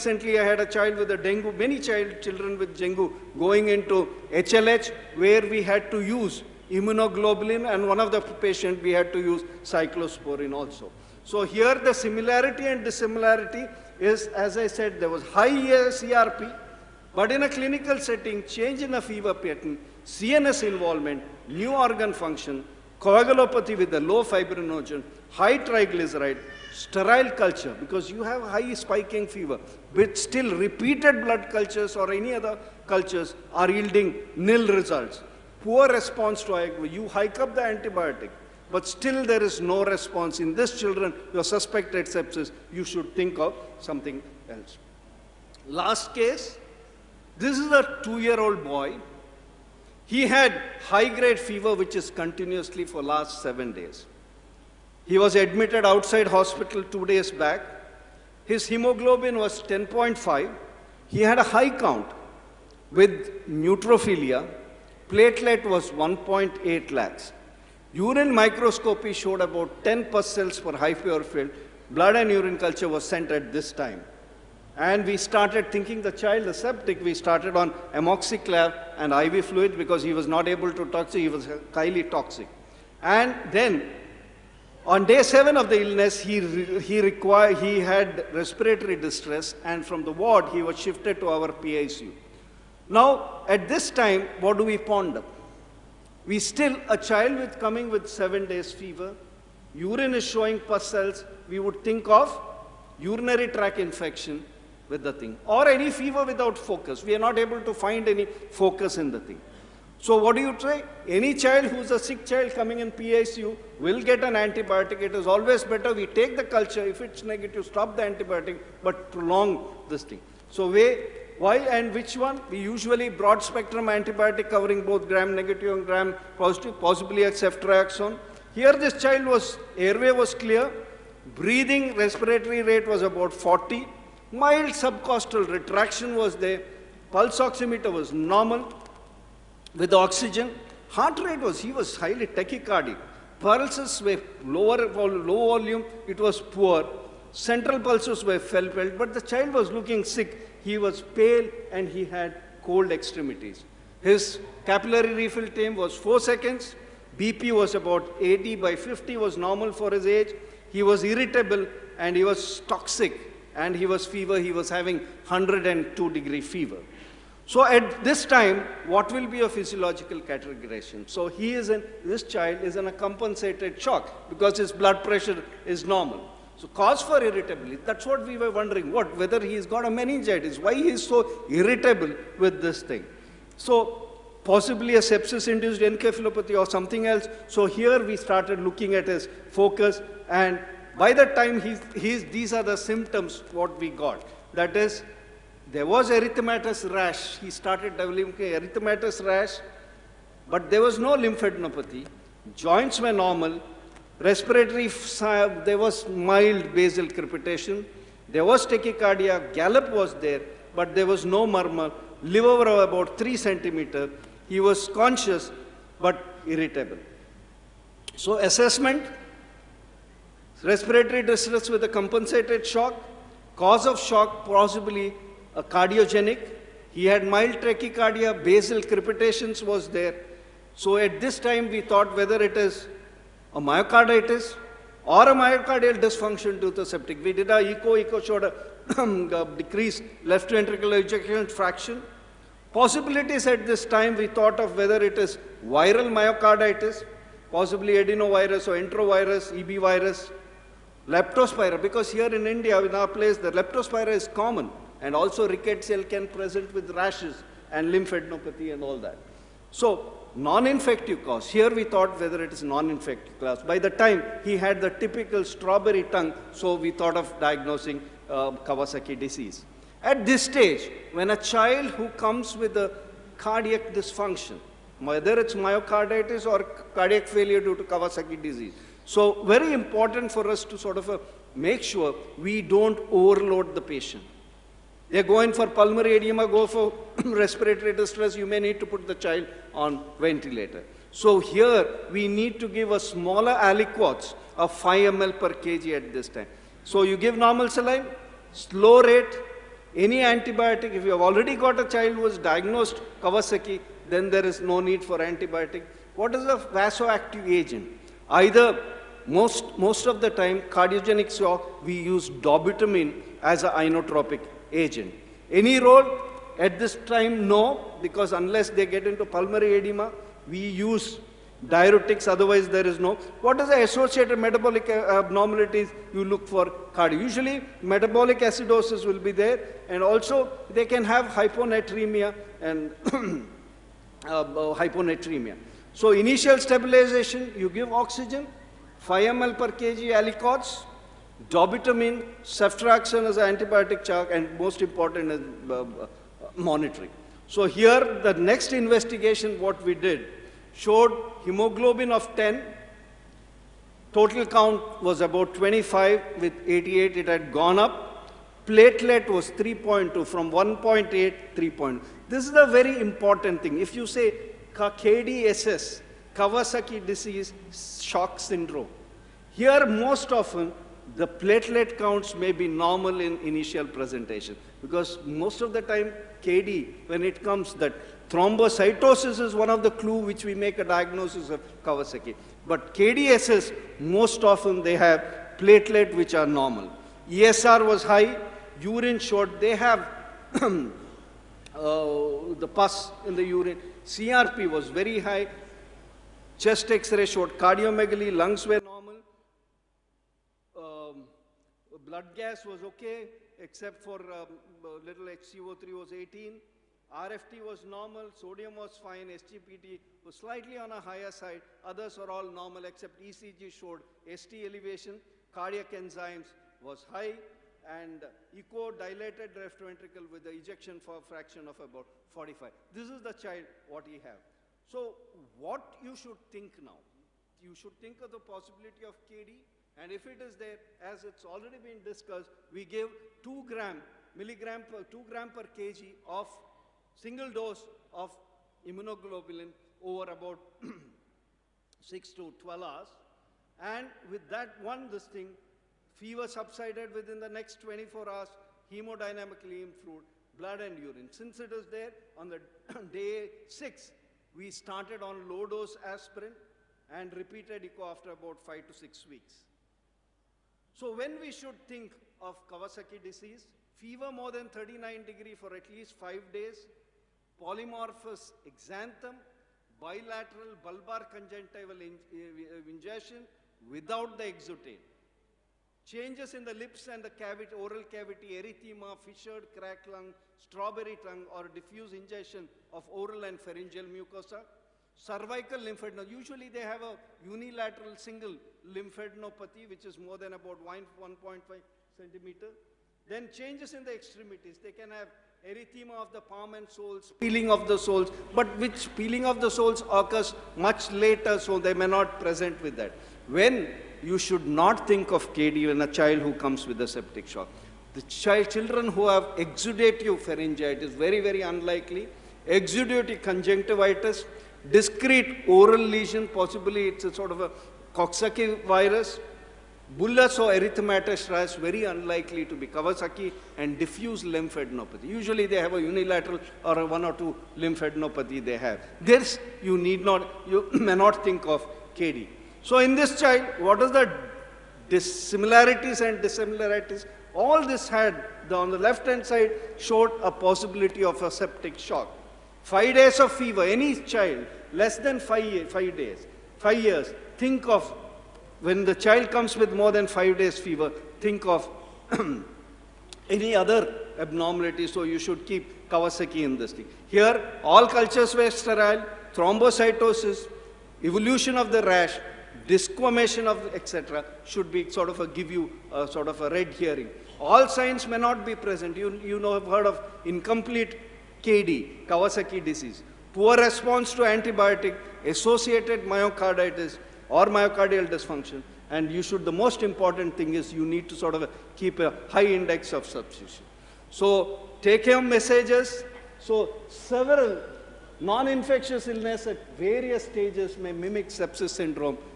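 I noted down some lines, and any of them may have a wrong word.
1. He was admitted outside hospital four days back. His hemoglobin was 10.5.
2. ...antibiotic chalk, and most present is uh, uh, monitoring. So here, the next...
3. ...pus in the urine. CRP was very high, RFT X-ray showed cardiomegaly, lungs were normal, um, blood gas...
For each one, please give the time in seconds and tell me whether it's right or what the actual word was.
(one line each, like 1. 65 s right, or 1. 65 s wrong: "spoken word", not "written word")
1. 55 s wrong: "two", not "four"
2. 343 s wrong: "important", not "present"
3. 392 s wrong: "Chest", not "RFT".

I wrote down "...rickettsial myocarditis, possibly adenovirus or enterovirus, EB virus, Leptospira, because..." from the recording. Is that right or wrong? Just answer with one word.
wrong.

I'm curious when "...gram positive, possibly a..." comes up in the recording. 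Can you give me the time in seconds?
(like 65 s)
125 s.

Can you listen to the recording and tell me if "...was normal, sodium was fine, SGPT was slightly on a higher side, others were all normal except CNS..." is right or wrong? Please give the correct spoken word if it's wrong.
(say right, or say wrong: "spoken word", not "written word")
wrong: "ECG", not "CNS".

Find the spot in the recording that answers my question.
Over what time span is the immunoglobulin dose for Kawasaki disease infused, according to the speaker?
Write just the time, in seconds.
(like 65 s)
442 s.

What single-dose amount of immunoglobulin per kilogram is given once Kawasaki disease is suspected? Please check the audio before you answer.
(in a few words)
2 g per kg.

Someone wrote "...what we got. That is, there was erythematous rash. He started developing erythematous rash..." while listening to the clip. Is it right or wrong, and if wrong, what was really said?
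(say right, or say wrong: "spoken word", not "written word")
right.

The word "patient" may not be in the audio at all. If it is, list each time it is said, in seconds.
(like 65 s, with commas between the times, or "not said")
8 s, 283 s.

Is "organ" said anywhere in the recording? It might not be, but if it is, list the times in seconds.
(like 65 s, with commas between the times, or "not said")
21 s.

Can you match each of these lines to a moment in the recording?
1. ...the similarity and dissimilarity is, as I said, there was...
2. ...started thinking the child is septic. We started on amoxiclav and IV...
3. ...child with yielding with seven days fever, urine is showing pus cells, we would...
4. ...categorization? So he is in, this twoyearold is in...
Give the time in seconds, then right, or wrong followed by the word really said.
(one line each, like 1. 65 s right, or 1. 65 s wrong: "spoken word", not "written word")
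1. 11 s right
2. 75 s right
3. 96 s wrong: "coming", not "yielding"
4. 170 s wrong: "child", not "twoyearold".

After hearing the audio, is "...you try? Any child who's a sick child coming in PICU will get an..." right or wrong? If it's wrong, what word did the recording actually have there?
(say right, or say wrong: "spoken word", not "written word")
right.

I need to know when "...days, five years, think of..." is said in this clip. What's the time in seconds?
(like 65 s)
546 s.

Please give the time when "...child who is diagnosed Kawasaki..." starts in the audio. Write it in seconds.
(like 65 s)
301 s.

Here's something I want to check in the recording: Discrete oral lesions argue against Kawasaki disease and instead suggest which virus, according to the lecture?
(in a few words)
Coxsackie virus.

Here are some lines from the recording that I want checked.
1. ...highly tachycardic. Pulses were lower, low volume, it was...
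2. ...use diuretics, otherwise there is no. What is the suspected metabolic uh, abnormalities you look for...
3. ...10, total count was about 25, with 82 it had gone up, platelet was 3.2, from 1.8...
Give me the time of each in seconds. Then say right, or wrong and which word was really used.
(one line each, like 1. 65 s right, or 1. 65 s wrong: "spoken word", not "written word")
1. 141 s right
2. 320 s wrong: "associated", not "suspected"
3. 352 s wrong: "88", not "82".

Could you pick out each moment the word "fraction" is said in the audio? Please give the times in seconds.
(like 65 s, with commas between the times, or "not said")
241 s, 421 s.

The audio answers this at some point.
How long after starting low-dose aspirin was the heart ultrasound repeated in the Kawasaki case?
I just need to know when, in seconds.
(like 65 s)
458 s.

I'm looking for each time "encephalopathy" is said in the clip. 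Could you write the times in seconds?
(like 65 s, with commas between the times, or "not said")
185 s.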